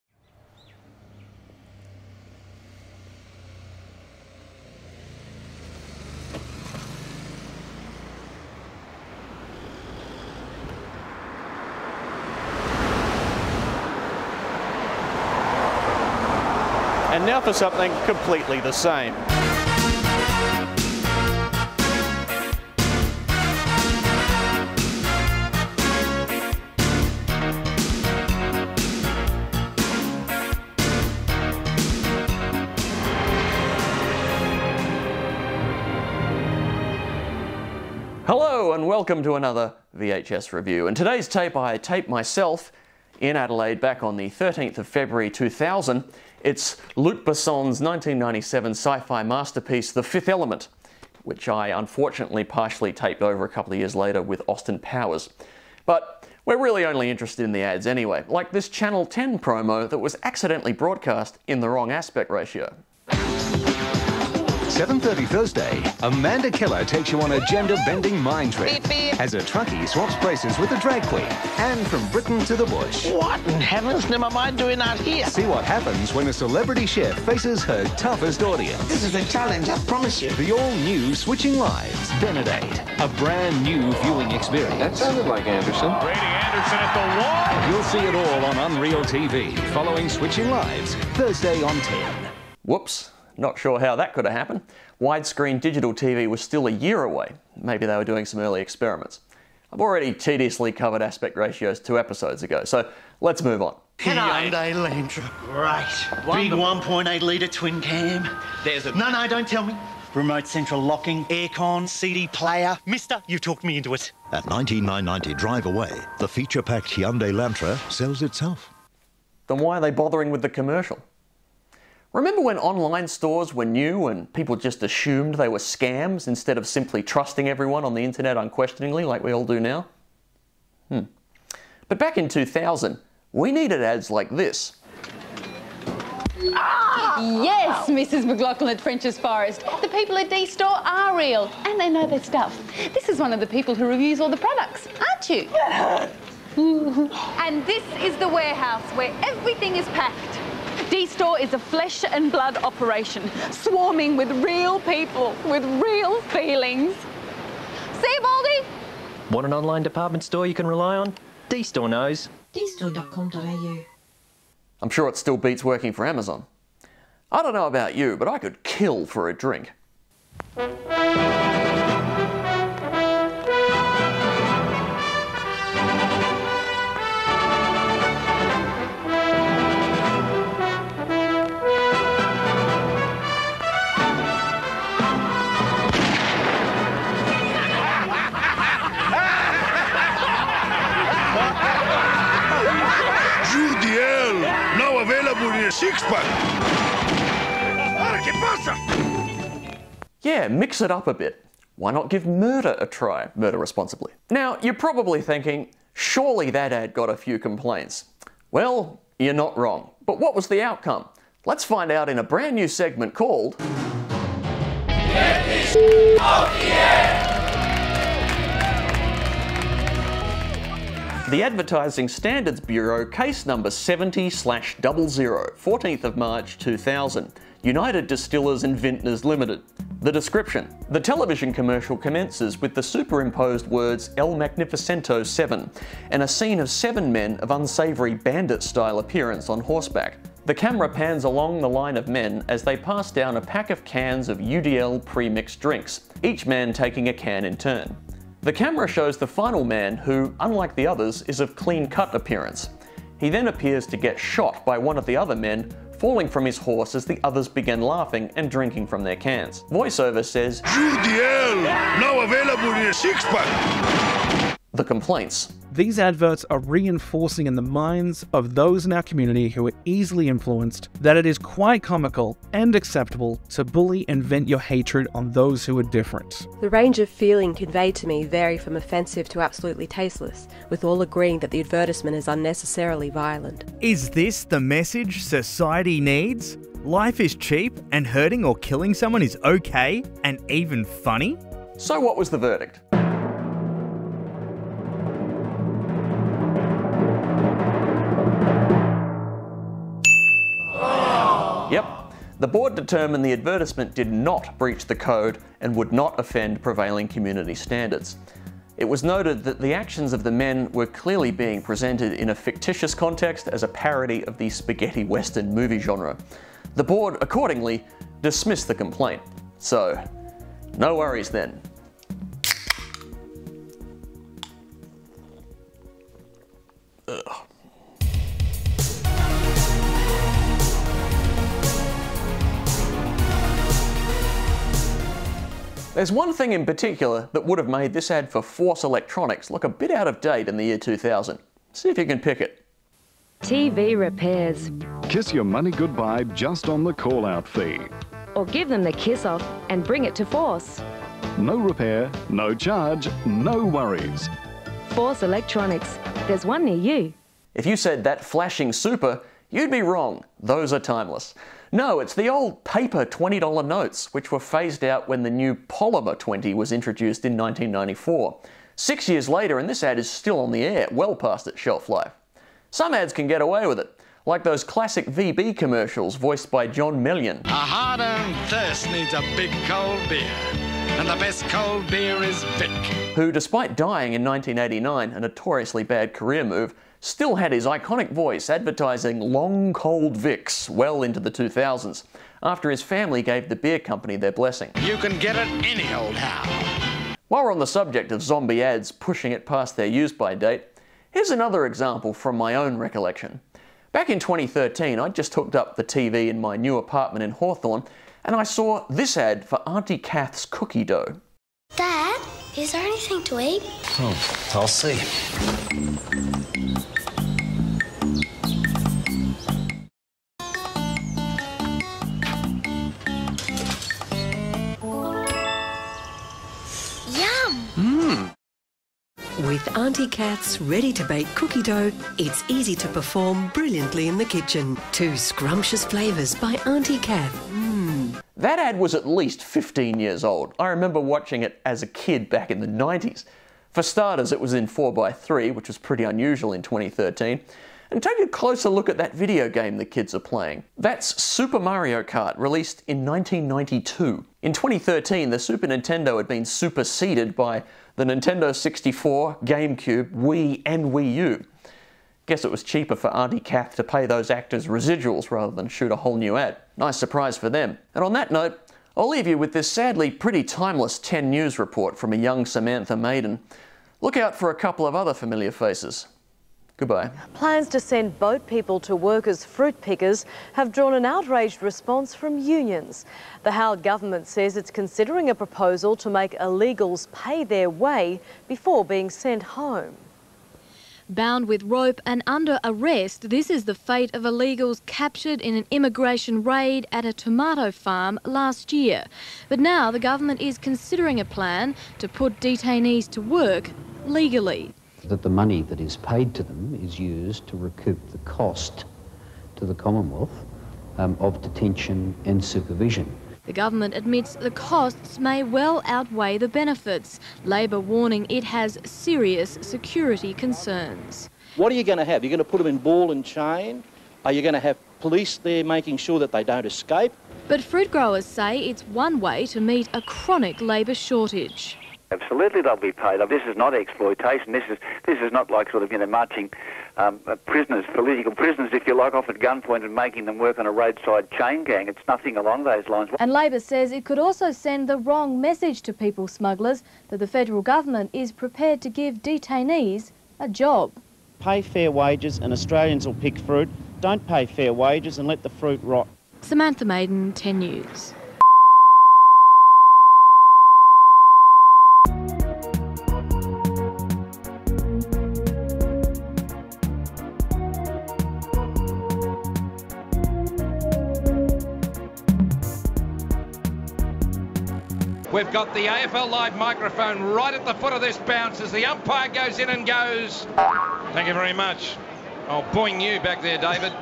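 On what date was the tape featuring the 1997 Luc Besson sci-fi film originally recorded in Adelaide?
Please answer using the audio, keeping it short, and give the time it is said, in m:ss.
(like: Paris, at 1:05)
13 February 2000, at 0:44.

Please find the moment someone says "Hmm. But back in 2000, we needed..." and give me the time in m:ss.
2:10.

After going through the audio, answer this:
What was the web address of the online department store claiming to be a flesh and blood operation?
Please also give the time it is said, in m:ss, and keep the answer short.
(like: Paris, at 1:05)
dstore.com.au, at 2:42.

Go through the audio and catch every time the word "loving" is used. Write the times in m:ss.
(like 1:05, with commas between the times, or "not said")
not said.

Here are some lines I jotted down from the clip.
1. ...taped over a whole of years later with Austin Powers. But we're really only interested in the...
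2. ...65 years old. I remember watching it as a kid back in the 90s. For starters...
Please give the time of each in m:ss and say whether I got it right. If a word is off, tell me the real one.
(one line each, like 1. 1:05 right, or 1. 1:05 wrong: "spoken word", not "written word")
1. 0:52 wrong: "couple", not "whole"
2. 7:19 wrong: "15", not "65".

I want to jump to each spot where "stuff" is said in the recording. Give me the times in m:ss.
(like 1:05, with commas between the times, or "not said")
2:22.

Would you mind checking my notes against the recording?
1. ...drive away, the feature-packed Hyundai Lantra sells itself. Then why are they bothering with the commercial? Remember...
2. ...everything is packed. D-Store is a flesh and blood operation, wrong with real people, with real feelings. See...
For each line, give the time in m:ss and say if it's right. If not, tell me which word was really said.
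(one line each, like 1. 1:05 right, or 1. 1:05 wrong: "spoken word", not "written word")
1. 1:55 right
2. 2:29 wrong: "swarming", not "wrong".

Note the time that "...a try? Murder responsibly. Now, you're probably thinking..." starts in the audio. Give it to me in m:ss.
3:22.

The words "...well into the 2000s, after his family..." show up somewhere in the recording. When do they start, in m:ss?
6:30.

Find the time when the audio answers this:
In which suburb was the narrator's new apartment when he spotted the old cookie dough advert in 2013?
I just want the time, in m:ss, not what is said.
6:47.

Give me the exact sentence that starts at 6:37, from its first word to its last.
While we're on the subject of zombie ads pushing it past their use by date, here's another example from my own recollection.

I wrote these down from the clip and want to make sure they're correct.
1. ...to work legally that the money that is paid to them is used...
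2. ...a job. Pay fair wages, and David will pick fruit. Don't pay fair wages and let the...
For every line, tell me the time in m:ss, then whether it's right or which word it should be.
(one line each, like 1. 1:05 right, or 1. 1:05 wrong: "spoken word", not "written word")
1. 8:23 right
2. 9:10 wrong: "Australians", not "David".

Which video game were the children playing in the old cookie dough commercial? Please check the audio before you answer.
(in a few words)
Super Mario Kart.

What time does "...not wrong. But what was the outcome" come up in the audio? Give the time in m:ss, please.
3:29.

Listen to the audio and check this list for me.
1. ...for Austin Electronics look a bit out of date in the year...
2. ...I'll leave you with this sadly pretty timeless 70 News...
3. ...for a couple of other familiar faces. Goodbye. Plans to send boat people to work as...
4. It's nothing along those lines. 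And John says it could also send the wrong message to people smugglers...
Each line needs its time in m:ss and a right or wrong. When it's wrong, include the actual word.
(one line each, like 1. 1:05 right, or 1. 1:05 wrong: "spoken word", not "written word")
1. 5:38 wrong: "Force", not "Austin"
2. 7:48 wrong: "10", not "70"
3. 7:54 right
4. 9:01 wrong: "Labor", not "John".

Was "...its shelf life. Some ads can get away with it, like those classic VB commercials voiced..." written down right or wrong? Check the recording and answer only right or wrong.
right.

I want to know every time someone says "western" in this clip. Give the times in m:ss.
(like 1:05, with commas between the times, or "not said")
5:15.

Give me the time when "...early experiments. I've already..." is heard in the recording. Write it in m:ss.
1:38.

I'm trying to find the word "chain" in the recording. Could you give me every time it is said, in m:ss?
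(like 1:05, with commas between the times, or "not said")
8:43, 9:01.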